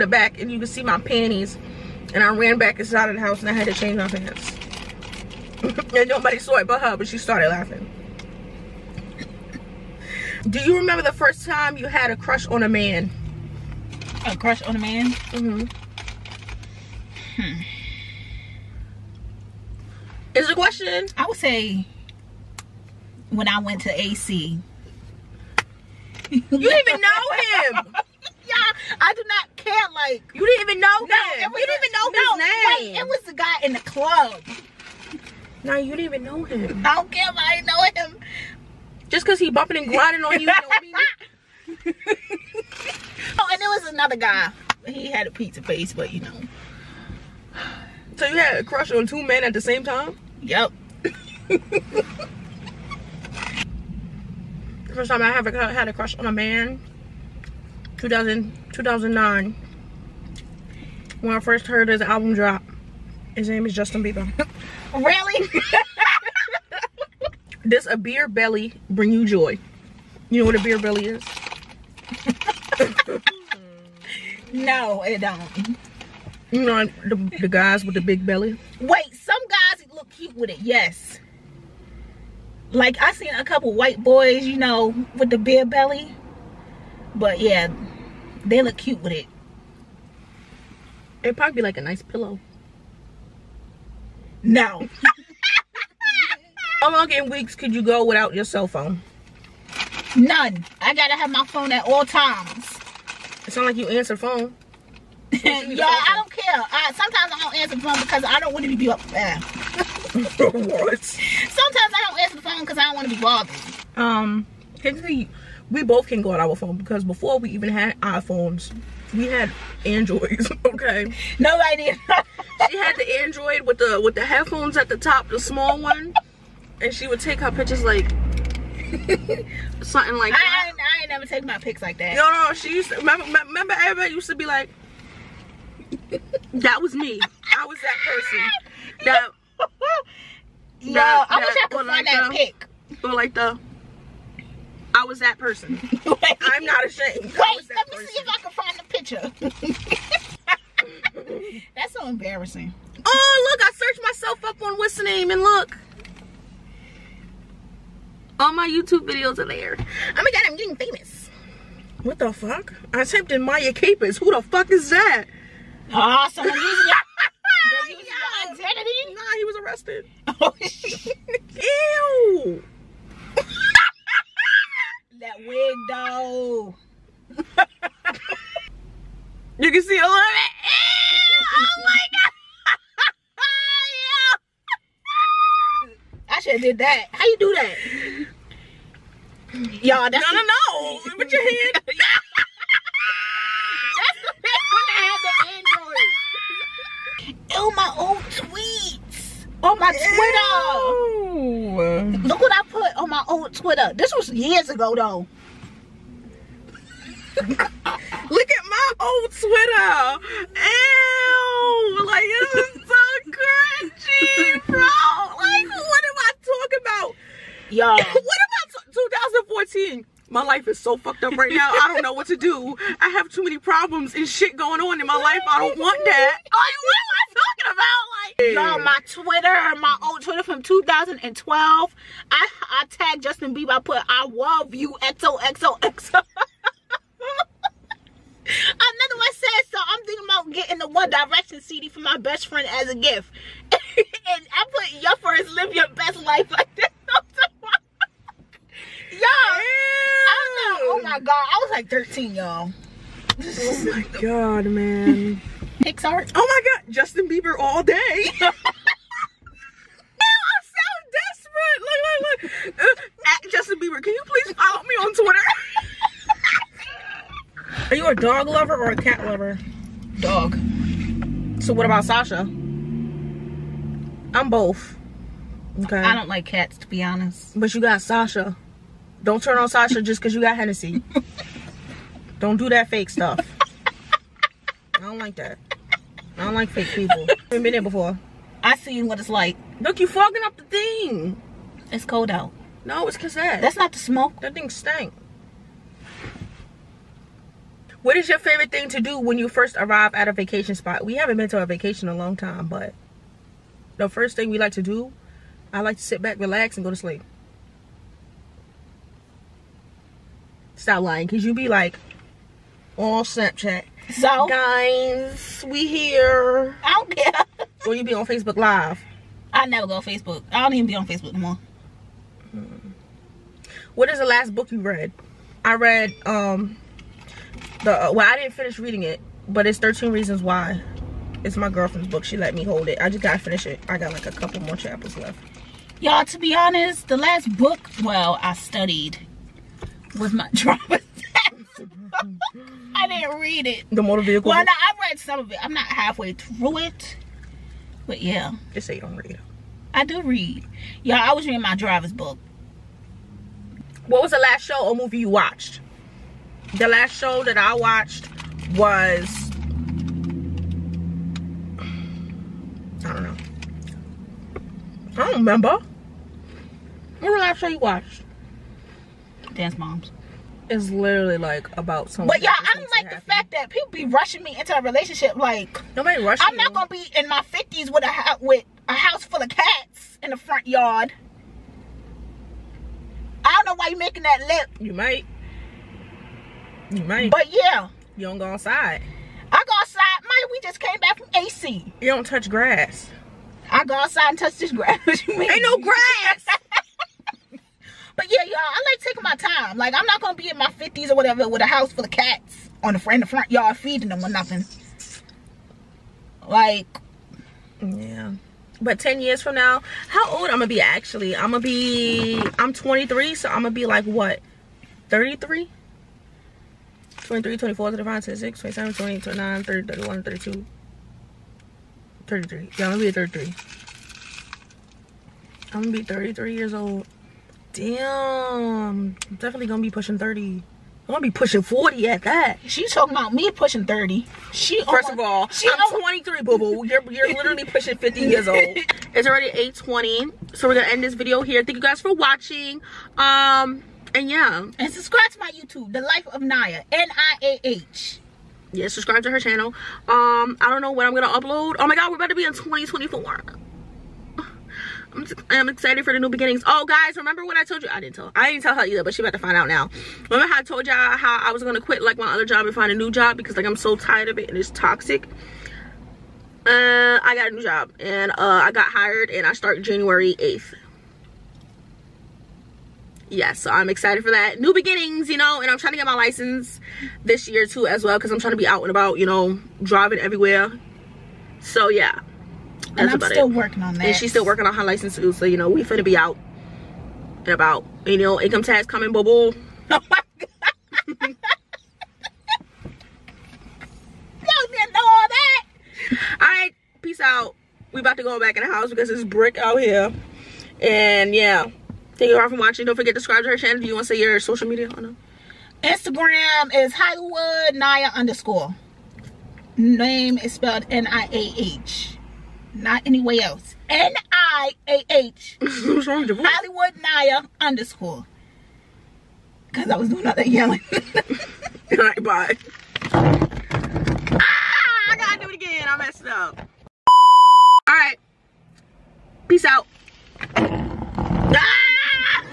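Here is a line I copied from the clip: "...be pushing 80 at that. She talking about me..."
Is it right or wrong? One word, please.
wrong.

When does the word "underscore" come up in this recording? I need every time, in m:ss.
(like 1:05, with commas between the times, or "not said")
8:28, 8:37.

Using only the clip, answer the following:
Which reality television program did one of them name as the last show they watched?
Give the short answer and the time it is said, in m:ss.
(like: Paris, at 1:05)
Dance Moms, at 6:09.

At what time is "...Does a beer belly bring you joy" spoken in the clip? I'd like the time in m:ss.
1:07.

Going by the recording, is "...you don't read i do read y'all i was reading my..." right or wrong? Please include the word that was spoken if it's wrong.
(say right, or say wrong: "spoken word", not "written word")
right.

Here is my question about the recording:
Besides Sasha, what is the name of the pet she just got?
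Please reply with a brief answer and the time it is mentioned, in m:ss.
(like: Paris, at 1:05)
Hennessy, at 4:40.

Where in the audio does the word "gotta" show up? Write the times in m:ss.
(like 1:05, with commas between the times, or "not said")
1:40, 5:33, 8:45.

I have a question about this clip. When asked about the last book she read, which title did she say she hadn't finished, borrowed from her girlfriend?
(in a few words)
13 Reasons Why.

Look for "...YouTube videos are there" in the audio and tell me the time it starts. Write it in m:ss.
2:38.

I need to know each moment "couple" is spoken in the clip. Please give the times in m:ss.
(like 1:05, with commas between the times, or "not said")
1:23, 5:34.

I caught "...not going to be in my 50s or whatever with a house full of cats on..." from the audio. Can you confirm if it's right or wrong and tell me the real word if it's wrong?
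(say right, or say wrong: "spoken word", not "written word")
right.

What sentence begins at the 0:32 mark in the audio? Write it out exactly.
Wait, it was the guy in the club.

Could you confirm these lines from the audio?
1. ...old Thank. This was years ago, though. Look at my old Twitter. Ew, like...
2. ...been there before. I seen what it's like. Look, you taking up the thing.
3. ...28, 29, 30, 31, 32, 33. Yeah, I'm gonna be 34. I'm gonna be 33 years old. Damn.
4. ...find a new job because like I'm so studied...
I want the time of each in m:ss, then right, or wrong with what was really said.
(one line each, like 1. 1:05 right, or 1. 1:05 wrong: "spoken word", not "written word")
1. 3:23 wrong: "Twitter", not "Thank"
2. 4:47 wrong: "fogging", not "taking"
3. 6:58 wrong: "33", not "34"
4. 7:42 wrong: "tired", not "studied".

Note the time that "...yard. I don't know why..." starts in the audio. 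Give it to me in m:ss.
6:20.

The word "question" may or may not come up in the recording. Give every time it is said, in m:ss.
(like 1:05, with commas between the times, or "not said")
0:20.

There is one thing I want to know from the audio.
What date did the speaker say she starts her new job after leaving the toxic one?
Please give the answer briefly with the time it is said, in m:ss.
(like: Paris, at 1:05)
January 8th, at 7:49.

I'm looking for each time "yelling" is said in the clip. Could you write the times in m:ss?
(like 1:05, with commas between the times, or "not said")
8:40.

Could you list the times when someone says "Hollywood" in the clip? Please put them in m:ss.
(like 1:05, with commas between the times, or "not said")
8:26, 8:36.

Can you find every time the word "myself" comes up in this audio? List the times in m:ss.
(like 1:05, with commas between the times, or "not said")
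2:34.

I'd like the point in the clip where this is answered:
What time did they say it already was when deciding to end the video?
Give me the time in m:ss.
7:19.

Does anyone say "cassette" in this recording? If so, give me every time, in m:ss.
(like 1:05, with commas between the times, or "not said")
4:53.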